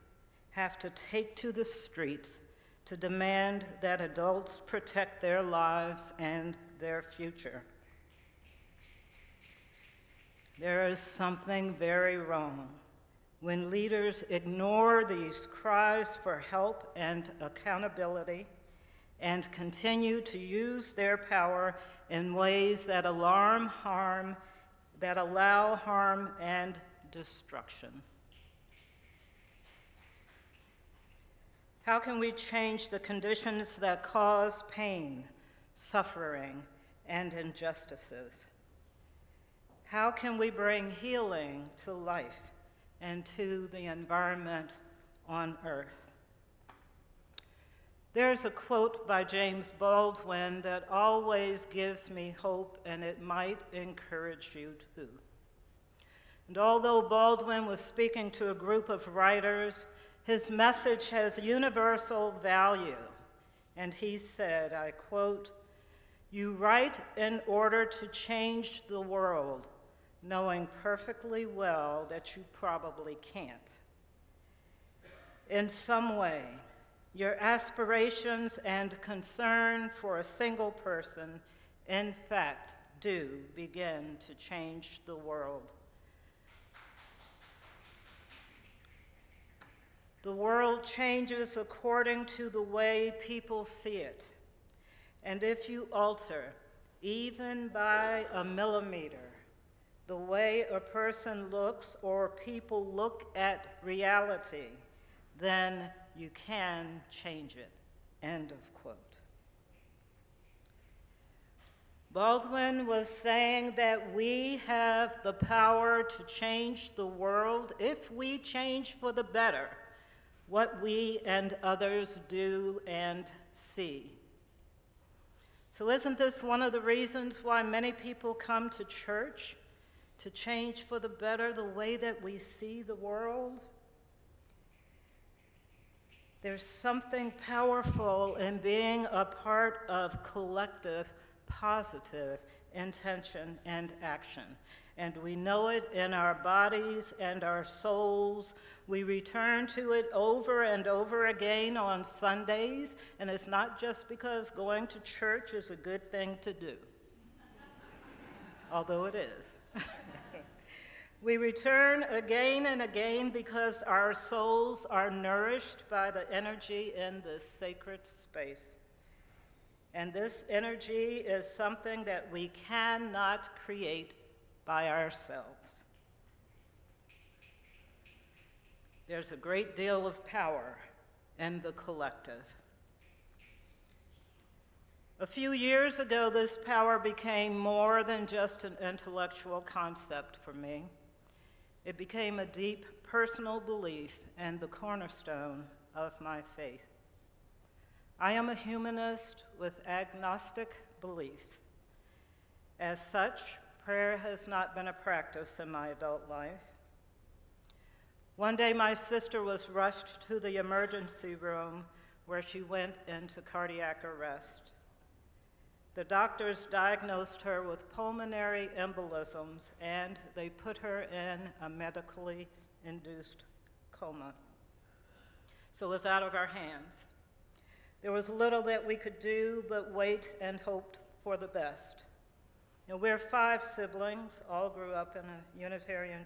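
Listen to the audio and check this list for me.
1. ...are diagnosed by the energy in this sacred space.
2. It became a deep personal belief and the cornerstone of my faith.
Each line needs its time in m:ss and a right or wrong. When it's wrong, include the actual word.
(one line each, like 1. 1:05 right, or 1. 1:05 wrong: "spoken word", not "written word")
1. 2:44 wrong: "nourished", not "diagnosed"
2. 3:11 right.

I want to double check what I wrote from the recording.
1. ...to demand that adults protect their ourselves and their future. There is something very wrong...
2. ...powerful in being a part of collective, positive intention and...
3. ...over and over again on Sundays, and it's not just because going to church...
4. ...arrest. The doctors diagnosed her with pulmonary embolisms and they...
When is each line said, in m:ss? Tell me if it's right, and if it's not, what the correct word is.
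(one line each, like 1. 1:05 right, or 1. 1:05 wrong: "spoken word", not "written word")
1. 0:02 wrong: "lives", not "ourselves"
2. 2:17 right
3. 2:30 right
4. 3:34 right.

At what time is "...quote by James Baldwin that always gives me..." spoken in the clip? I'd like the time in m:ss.
0:48.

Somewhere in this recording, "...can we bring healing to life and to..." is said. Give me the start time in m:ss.
0:40.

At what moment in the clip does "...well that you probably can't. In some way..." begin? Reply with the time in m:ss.
1:11.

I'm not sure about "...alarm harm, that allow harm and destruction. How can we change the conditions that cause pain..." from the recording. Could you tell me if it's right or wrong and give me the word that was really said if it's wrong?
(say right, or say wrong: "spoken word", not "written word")
right.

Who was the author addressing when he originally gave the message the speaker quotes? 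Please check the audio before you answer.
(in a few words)
a group of writers.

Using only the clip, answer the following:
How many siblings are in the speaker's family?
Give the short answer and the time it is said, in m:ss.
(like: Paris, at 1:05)
5, at 3:53.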